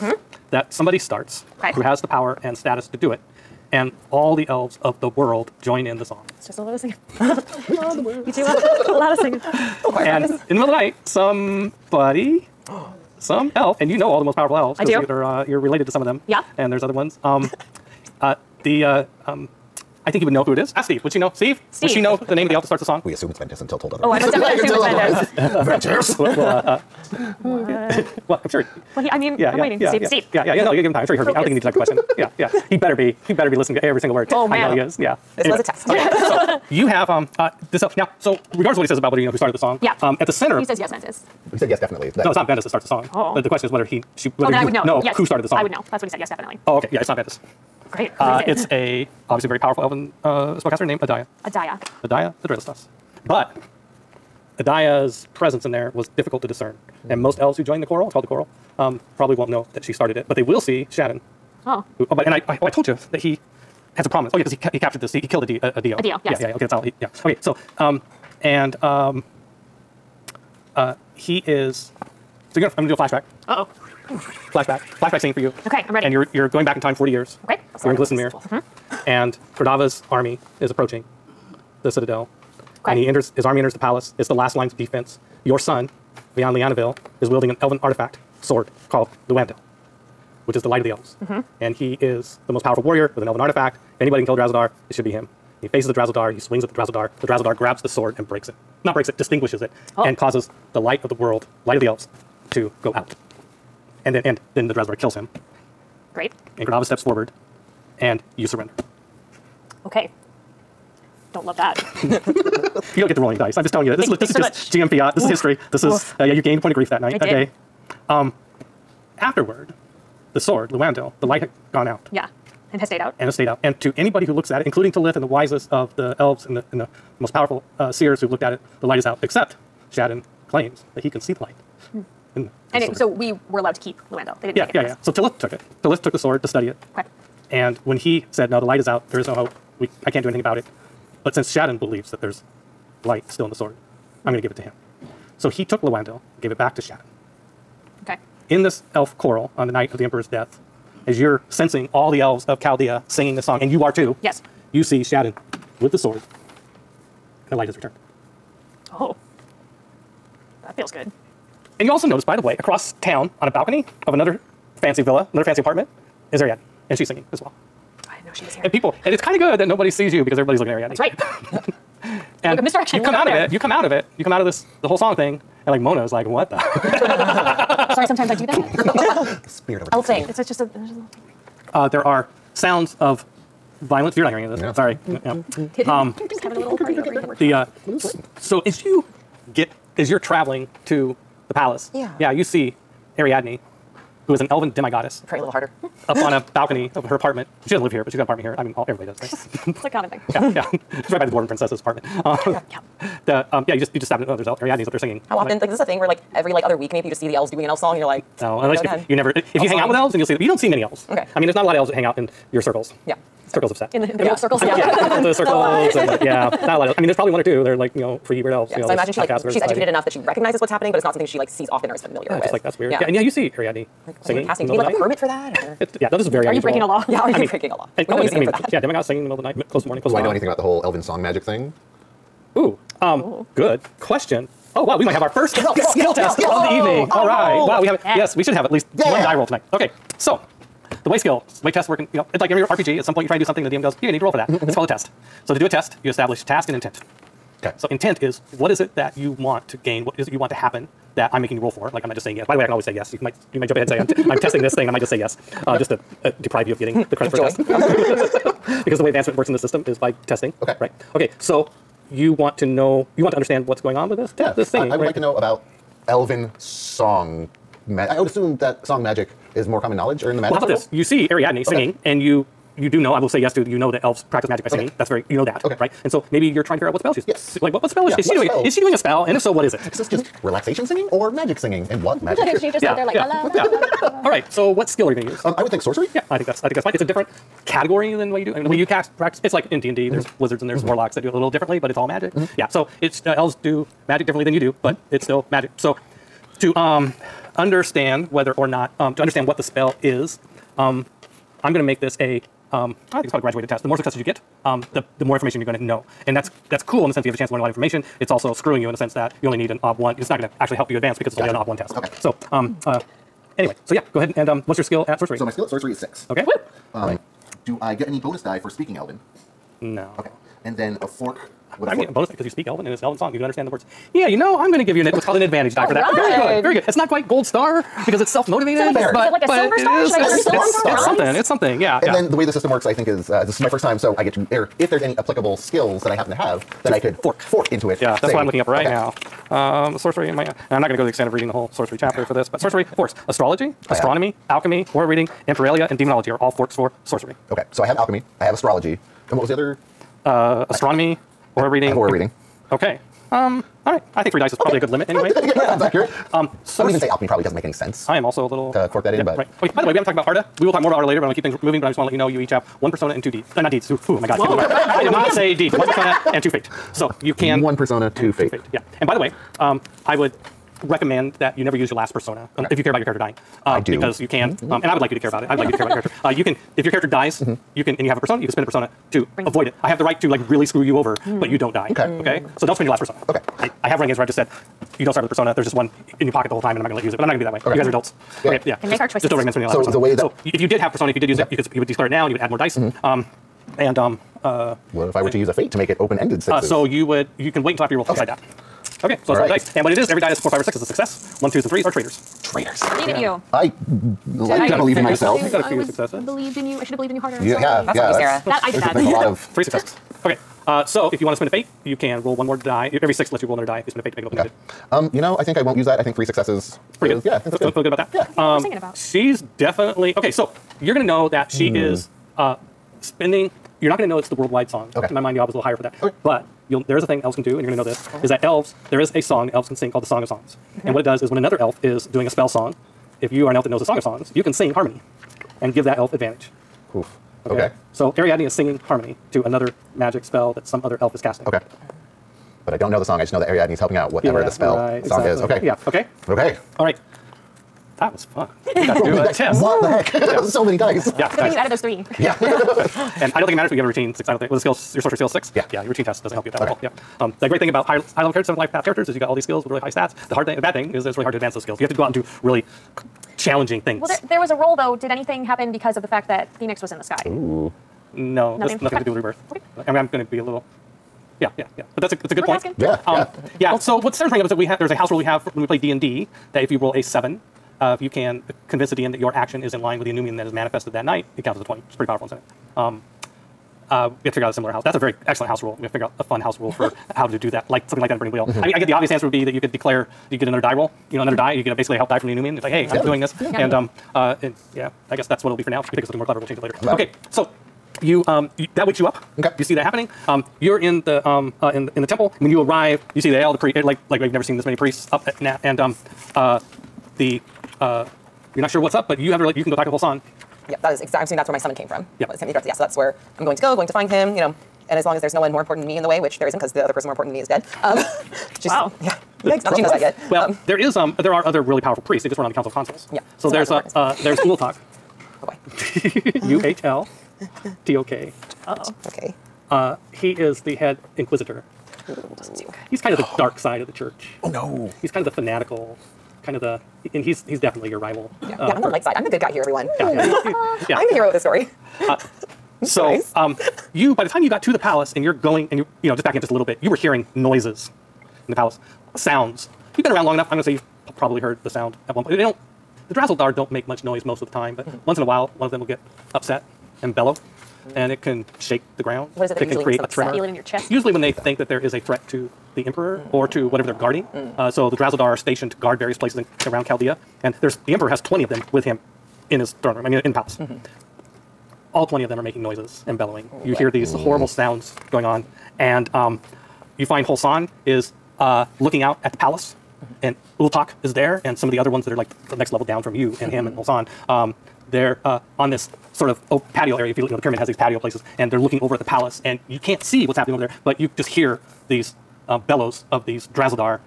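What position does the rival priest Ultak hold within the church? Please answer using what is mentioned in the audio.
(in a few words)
head inquisitor.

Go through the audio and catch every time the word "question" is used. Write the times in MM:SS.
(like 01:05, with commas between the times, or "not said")
00:31, 00:43, 03:54.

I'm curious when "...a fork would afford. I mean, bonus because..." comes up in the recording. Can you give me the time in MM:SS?
05:21.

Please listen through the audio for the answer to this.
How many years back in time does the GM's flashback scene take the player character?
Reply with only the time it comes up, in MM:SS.
01:16.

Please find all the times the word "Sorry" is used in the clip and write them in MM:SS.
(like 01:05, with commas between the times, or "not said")
02:57, 03:04.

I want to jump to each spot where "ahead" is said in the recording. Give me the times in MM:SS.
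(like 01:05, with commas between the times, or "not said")
04:13, 05:14.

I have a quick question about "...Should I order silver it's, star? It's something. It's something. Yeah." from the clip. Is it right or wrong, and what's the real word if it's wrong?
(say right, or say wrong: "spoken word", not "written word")
right.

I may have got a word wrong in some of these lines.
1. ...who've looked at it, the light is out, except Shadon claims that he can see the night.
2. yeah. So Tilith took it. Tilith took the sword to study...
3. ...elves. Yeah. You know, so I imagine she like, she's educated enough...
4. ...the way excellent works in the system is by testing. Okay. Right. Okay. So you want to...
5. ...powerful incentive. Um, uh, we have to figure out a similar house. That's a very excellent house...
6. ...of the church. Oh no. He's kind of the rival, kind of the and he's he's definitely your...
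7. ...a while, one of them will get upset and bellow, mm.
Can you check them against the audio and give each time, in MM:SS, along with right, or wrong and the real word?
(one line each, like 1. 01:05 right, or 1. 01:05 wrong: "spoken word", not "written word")
1. 02:08 wrong: "light", not "night"
2. 02:14 right
3. 03:38 right
4. 04:18 wrong: "advancement", not "excellent"
5. 08:02 right
6. 08:53 wrong: "fanatical", not "rival"
7. 09:15 right.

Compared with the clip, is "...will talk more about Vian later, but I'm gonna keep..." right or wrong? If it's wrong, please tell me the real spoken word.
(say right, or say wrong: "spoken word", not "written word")
wrong: "Arda", not "Vian".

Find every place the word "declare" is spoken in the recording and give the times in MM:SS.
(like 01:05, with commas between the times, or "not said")
06:31, 08:09.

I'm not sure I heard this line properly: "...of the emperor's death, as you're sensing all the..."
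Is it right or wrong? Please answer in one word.
right.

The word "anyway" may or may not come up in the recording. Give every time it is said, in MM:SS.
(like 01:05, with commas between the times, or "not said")
00:35, 05:13, 05:55.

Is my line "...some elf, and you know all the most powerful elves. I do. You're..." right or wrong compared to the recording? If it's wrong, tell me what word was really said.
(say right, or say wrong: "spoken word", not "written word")
right.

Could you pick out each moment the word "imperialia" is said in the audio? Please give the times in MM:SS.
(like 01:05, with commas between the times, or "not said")
05:45.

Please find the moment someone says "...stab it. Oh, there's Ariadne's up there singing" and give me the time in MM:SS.
03:24.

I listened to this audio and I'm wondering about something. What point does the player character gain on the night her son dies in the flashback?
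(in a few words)
grief.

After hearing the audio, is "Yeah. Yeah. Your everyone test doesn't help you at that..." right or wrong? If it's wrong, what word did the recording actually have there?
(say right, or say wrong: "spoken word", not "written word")
wrong: "routine", not "everyone".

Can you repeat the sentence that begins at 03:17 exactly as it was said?
She doesn't live here, but she's got an apartment here.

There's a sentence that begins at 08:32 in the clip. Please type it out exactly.
Yeah, so that's where I'm going to go.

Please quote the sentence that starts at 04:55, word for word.
So to um, understand whether or not um, to understand what the spell is, um, I'm going to make this a.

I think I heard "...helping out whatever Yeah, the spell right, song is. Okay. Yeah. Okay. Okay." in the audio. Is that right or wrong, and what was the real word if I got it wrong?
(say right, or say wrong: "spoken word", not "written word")
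right.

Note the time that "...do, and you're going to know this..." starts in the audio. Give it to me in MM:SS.
07:07.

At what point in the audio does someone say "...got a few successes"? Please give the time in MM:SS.
06:45.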